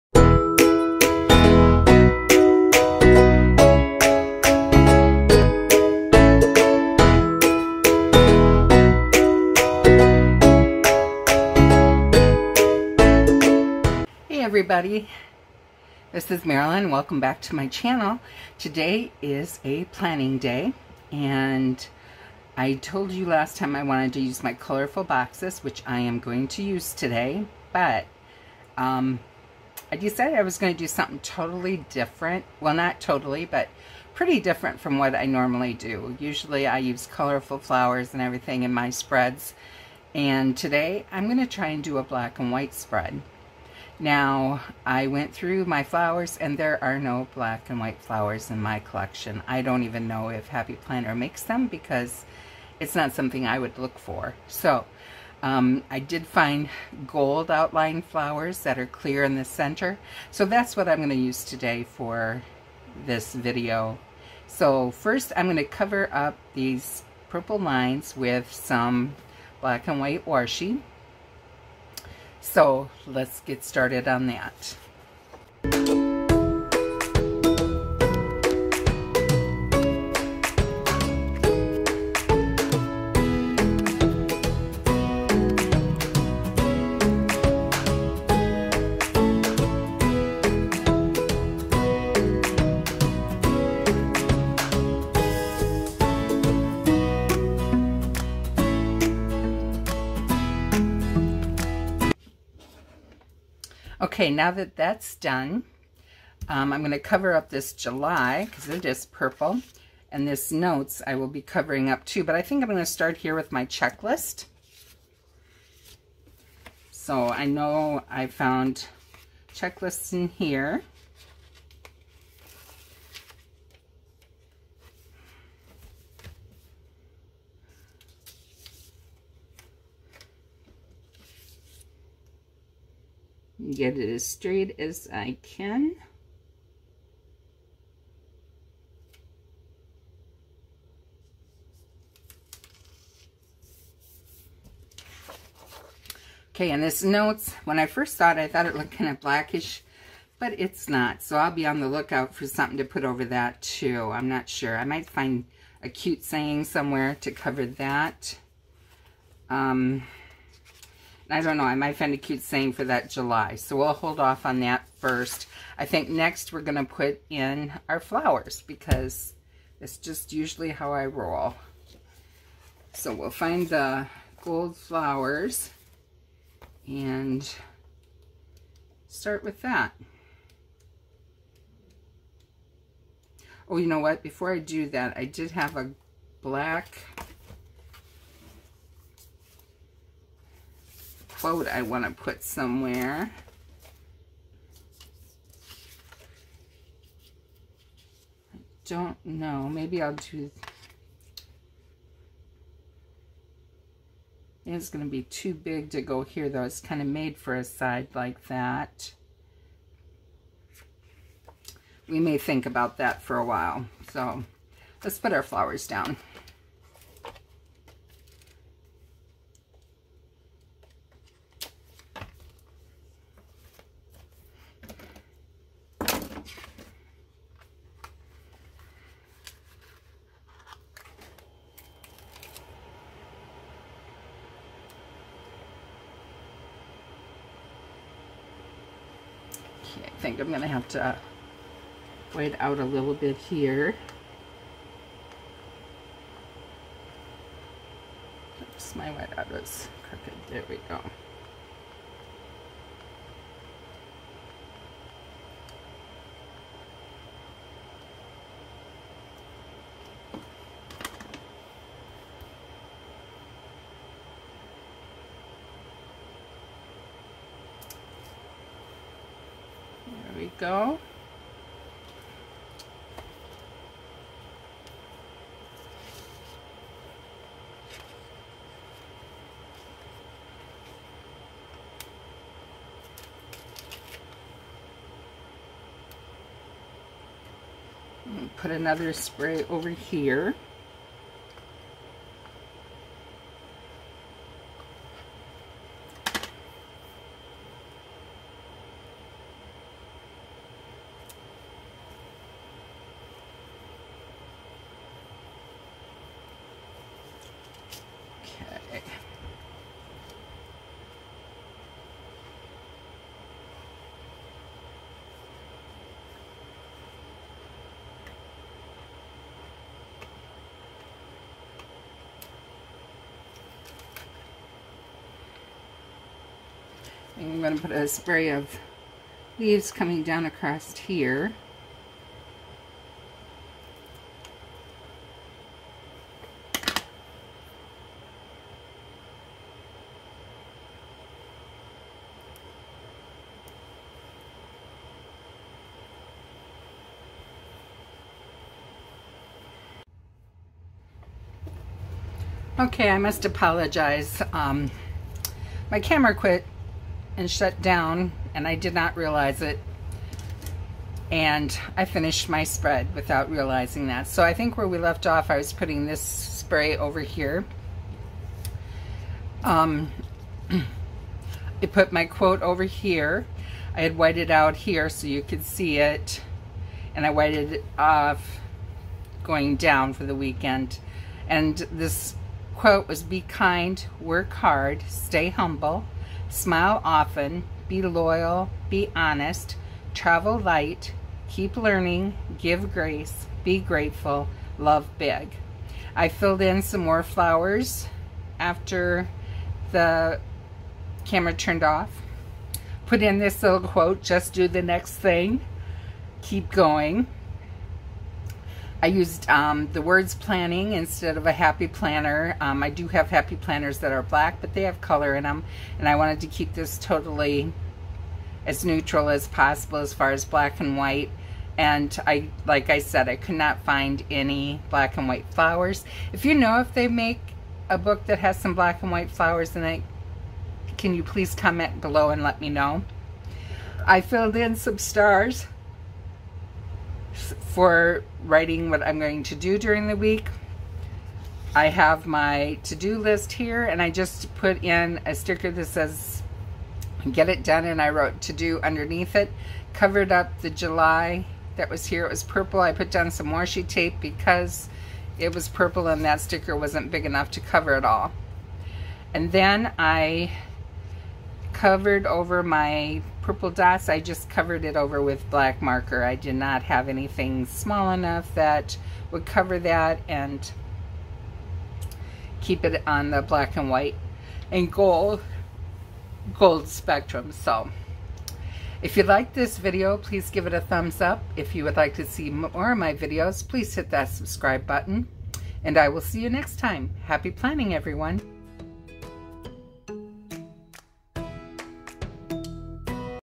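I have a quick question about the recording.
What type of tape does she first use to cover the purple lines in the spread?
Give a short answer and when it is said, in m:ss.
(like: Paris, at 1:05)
black and white washi, at 1:09.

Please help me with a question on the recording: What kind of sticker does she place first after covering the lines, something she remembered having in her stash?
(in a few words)
checklist.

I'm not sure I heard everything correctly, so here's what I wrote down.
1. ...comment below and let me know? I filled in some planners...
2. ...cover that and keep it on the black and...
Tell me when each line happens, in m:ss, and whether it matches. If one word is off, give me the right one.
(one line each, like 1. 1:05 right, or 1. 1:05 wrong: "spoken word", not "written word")
1. 7:11 wrong: "stars", not "planners"
2. 7:49 right.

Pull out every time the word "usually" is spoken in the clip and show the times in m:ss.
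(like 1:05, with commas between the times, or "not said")
0:36, 2:50.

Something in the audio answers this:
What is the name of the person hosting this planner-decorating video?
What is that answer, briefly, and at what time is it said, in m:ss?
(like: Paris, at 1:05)
Marilyn, at 0:16.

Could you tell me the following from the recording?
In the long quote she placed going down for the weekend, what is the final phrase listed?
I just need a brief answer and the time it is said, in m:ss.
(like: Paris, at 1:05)
love big, at 6:34.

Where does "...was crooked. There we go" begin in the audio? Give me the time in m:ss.
4:09.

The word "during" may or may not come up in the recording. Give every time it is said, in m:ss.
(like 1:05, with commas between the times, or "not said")
7:19.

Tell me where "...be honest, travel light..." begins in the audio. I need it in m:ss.
6:28.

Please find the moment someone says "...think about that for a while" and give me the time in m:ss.
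3:32.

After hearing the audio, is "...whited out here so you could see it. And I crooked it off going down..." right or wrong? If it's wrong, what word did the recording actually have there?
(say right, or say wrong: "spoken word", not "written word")
wrong: "whited", not "crooked".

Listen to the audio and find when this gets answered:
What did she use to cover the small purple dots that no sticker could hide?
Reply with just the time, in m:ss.
7:45.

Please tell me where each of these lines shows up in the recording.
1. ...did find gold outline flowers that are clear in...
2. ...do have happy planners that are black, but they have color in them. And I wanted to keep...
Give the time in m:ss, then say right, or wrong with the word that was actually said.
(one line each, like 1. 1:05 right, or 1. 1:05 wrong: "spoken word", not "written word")
1. 0:55 right
2. 6:52 right.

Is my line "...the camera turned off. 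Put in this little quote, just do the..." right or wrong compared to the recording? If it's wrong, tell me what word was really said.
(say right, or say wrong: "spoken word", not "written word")
right.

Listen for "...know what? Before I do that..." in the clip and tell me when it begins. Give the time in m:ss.
3:03.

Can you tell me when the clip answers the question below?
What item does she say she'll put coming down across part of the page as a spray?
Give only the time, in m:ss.
5:29.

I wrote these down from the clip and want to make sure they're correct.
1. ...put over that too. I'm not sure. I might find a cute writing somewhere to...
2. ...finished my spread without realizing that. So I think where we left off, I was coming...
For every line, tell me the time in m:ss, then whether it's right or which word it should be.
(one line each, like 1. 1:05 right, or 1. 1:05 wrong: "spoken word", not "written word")
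1. 2:32 wrong: "saying", not "writing"
2. 6:02 wrong: "putting", not "coming".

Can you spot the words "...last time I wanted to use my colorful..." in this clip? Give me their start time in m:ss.
0:23.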